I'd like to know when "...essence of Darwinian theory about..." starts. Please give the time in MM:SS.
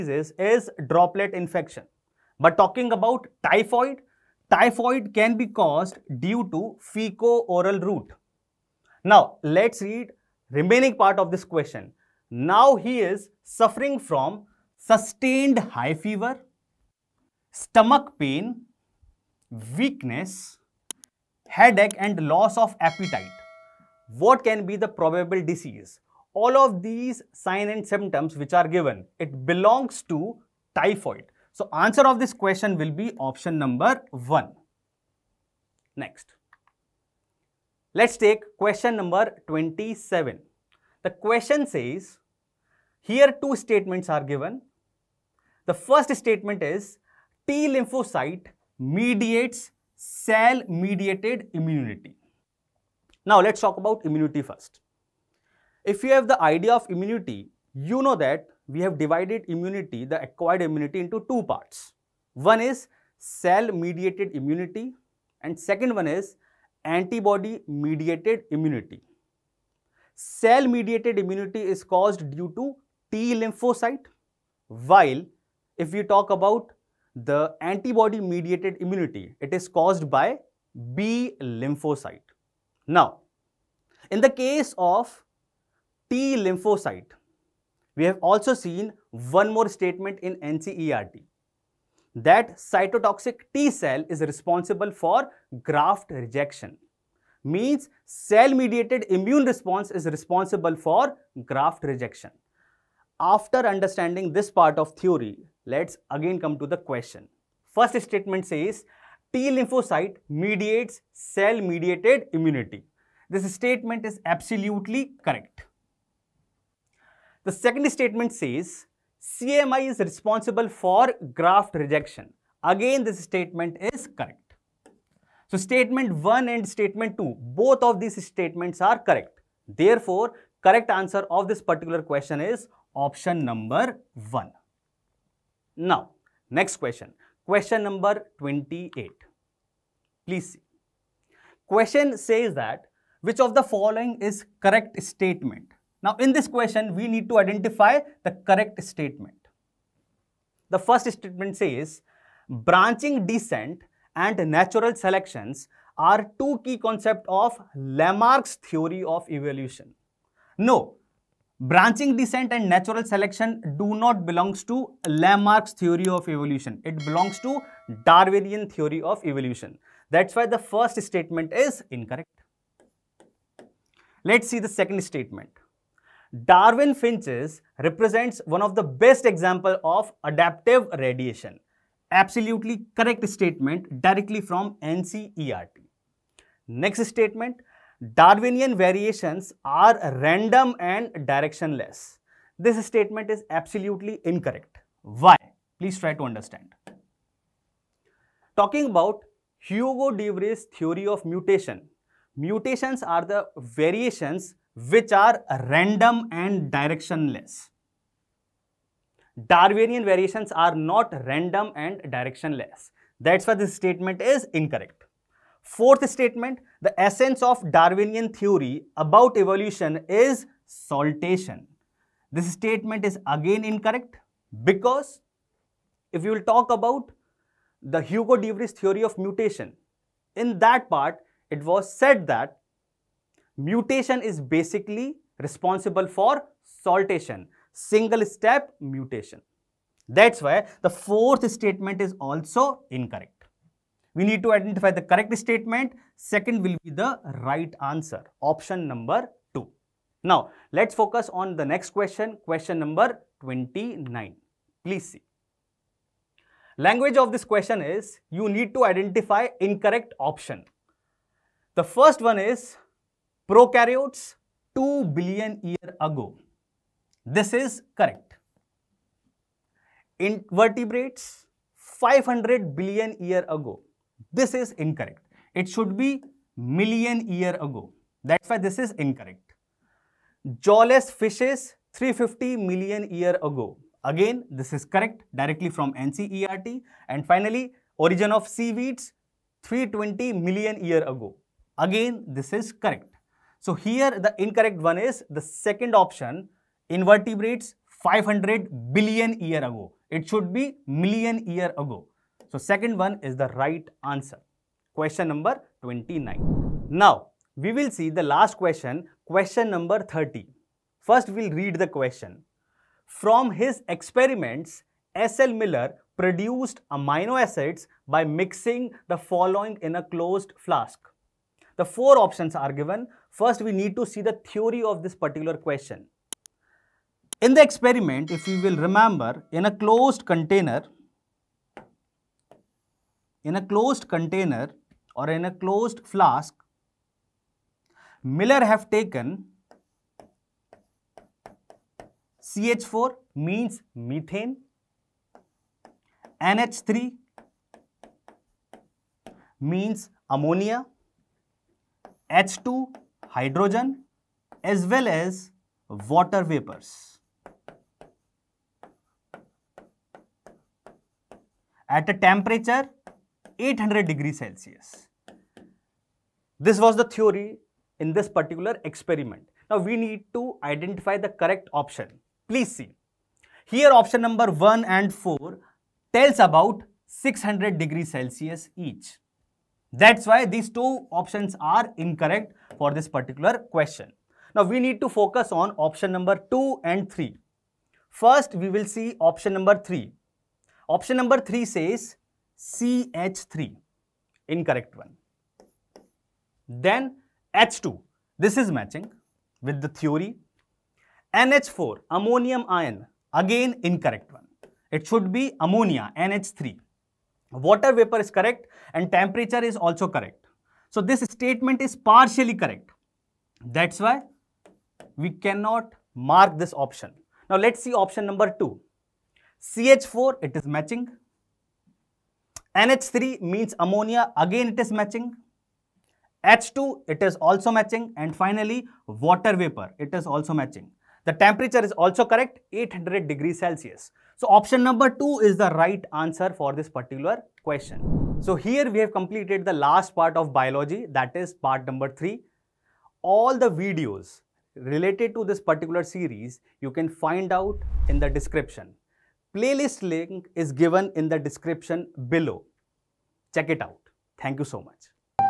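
03:37.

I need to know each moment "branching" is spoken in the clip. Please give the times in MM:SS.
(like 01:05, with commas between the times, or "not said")
02:32, 02:41.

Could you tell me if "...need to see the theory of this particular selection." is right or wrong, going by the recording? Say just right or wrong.
wrong.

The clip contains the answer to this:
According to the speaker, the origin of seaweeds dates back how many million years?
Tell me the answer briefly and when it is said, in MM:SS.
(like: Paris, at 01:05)
320, at 04:49.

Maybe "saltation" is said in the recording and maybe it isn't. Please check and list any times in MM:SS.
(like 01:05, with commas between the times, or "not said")
03:40, 03:56.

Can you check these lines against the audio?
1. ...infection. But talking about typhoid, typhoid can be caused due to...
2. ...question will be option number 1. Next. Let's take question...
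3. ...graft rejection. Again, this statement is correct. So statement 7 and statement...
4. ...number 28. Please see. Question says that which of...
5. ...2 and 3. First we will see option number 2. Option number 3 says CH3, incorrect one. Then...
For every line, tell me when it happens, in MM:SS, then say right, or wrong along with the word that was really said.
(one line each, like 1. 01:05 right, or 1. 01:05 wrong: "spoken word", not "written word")
1. 00:01 right
2. 00:32 right
3. 02:01 wrong: "1", not "7"
4. 02:17 right
5. 06:26 wrong: "3", not "2".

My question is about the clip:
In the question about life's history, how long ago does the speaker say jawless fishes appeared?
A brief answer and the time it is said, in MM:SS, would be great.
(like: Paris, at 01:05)
350 million years ago, at 04:41.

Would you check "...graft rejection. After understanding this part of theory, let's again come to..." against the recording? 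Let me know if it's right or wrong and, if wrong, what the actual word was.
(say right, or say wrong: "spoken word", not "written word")
right.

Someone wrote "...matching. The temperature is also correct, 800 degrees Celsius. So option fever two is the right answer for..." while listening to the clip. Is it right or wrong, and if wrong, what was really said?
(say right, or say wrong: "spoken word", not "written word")
wrong: "number", not "fever".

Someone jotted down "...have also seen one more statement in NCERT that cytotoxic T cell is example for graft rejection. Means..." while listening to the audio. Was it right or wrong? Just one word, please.
wrong.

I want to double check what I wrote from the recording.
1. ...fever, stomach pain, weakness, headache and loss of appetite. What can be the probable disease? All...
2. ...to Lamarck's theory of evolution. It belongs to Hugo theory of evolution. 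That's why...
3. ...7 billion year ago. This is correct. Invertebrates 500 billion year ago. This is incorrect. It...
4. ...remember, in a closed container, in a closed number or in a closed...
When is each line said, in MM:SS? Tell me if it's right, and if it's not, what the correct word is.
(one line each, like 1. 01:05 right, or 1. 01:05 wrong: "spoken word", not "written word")
1. 00:15 right
2. 02:44 wrong: "Darwinian", not "Hugo"
3. 04:24 wrong: "2", not "7"
4. 05:28 wrong: "container", not "number".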